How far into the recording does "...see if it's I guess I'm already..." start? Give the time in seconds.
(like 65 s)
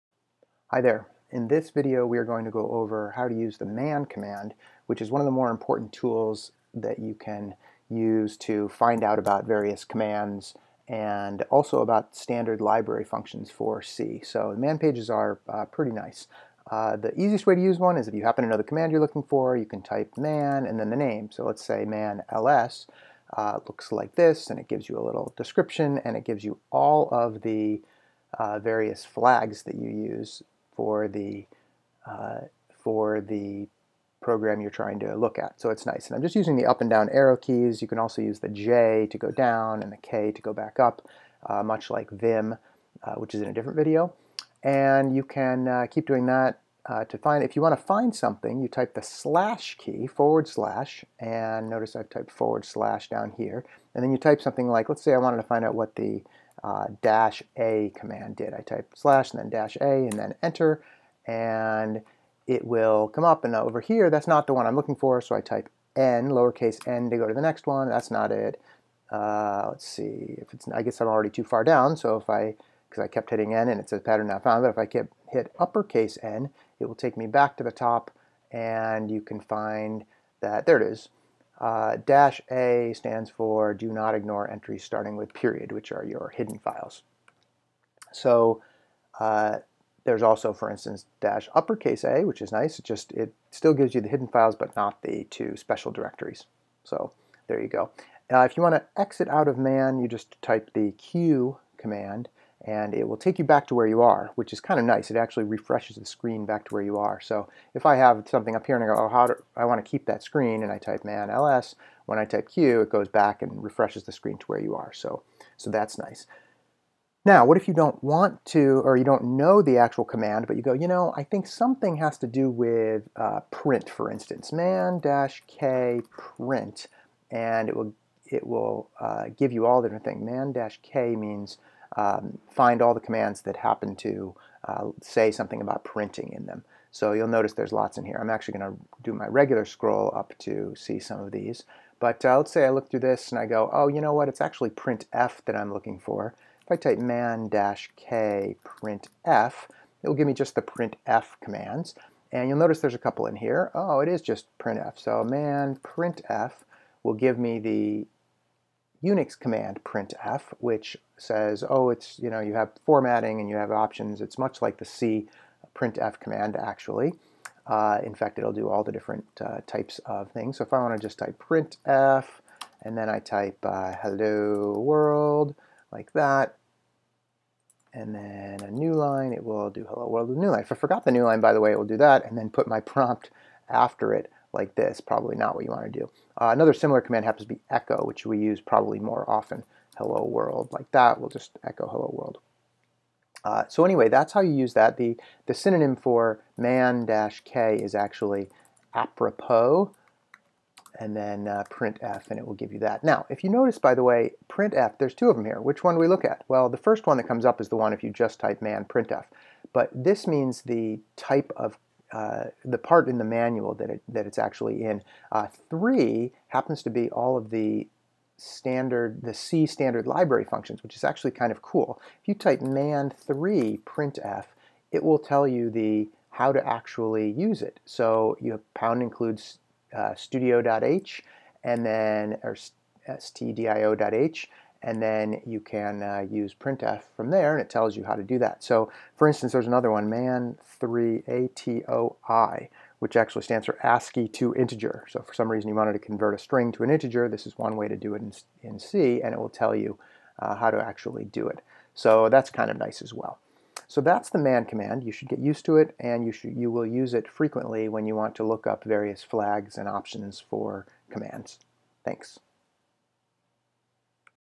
69 s.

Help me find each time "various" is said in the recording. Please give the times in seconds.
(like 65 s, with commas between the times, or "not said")
9 s, 28 s, 258 s.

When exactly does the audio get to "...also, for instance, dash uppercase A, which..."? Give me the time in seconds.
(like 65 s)
90 s.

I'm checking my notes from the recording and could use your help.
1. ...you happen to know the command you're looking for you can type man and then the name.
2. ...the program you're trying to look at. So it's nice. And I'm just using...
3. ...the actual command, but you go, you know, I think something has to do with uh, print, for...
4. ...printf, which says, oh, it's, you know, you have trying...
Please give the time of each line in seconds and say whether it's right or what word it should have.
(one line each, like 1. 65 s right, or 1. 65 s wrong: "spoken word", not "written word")
1. 18 s right
2. 33 s right
3. 119 s right
4. 159 s wrong: "formatting", not "trying".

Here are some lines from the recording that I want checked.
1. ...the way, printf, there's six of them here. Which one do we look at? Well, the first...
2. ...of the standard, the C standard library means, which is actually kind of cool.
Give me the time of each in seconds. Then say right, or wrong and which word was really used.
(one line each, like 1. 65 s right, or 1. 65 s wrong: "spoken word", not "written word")
1. 203 s wrong: "two", not "six"
2. 217 s wrong: "functions", not "means".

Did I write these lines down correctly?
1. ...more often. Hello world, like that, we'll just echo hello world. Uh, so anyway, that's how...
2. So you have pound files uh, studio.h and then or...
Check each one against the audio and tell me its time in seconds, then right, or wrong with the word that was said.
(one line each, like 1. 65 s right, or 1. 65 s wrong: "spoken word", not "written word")
1. 188 s right
2. 227 s wrong: "includes", not "files".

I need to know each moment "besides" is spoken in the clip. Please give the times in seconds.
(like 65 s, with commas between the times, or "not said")
not said.